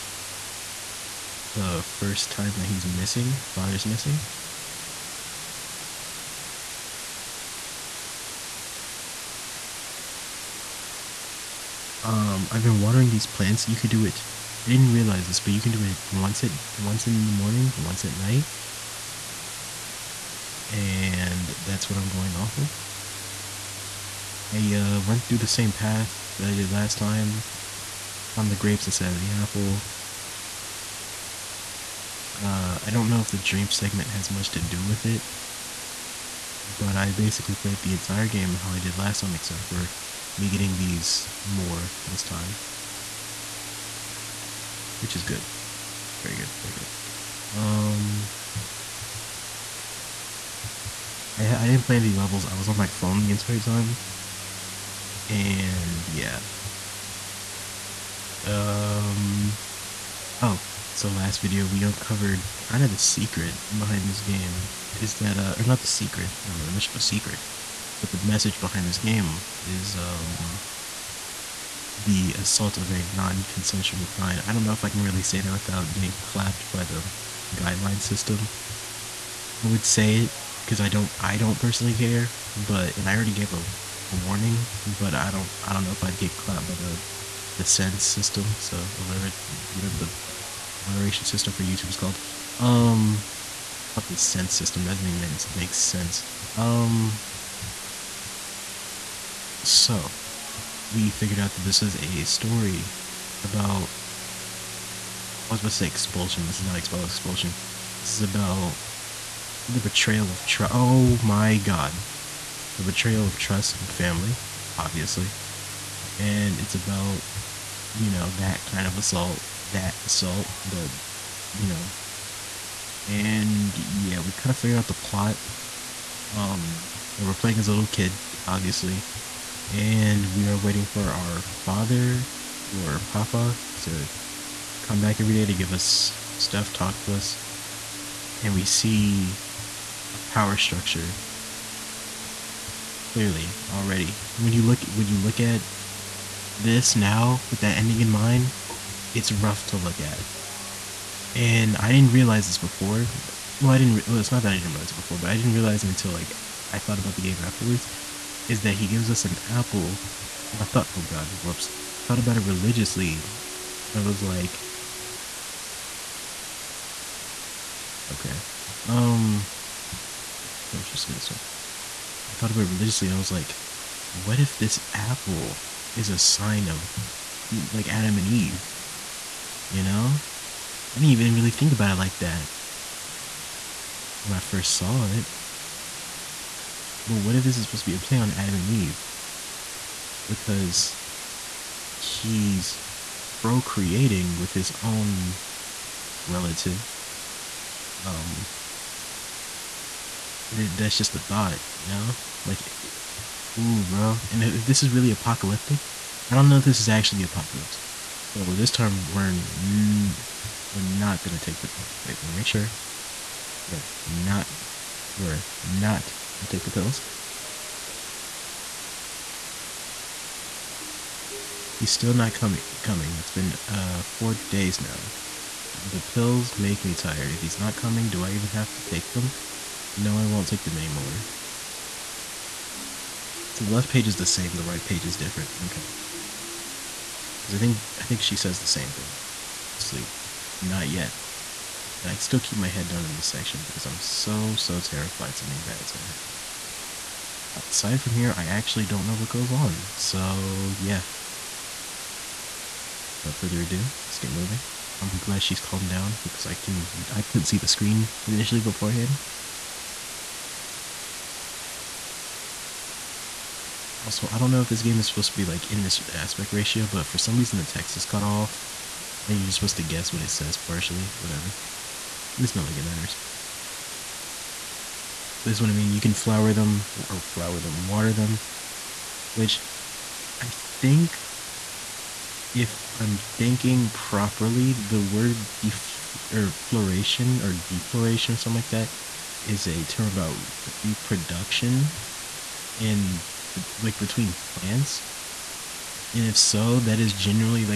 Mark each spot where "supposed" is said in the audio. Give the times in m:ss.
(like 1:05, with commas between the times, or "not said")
2:50, 3:07, 4:25, 4:29.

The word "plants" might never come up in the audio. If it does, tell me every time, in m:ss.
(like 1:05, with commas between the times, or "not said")
0:13, 4:54.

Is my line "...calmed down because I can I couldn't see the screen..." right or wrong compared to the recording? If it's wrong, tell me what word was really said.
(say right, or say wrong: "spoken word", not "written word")
right.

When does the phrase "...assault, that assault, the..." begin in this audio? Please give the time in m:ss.
1:58.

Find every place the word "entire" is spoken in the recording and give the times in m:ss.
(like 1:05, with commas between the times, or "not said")
0:37, 0:53.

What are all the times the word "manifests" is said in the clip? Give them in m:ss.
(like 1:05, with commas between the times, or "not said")
not said.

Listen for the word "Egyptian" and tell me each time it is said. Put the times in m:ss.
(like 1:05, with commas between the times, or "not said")
not said.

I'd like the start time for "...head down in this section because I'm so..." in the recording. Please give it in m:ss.
4:02.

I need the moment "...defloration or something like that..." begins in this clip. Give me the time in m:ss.
4:47.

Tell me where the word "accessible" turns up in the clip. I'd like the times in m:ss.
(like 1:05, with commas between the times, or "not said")
not said.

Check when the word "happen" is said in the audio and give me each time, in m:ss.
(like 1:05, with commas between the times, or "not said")
4:06.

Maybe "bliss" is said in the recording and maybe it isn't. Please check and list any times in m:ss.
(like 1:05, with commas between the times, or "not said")
not said.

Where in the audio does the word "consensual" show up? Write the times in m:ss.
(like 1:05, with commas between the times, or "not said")
1:13.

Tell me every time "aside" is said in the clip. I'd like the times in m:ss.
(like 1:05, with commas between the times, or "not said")
4:07.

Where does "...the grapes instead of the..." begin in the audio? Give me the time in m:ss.
0:28.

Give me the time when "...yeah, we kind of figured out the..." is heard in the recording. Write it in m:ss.
2:03.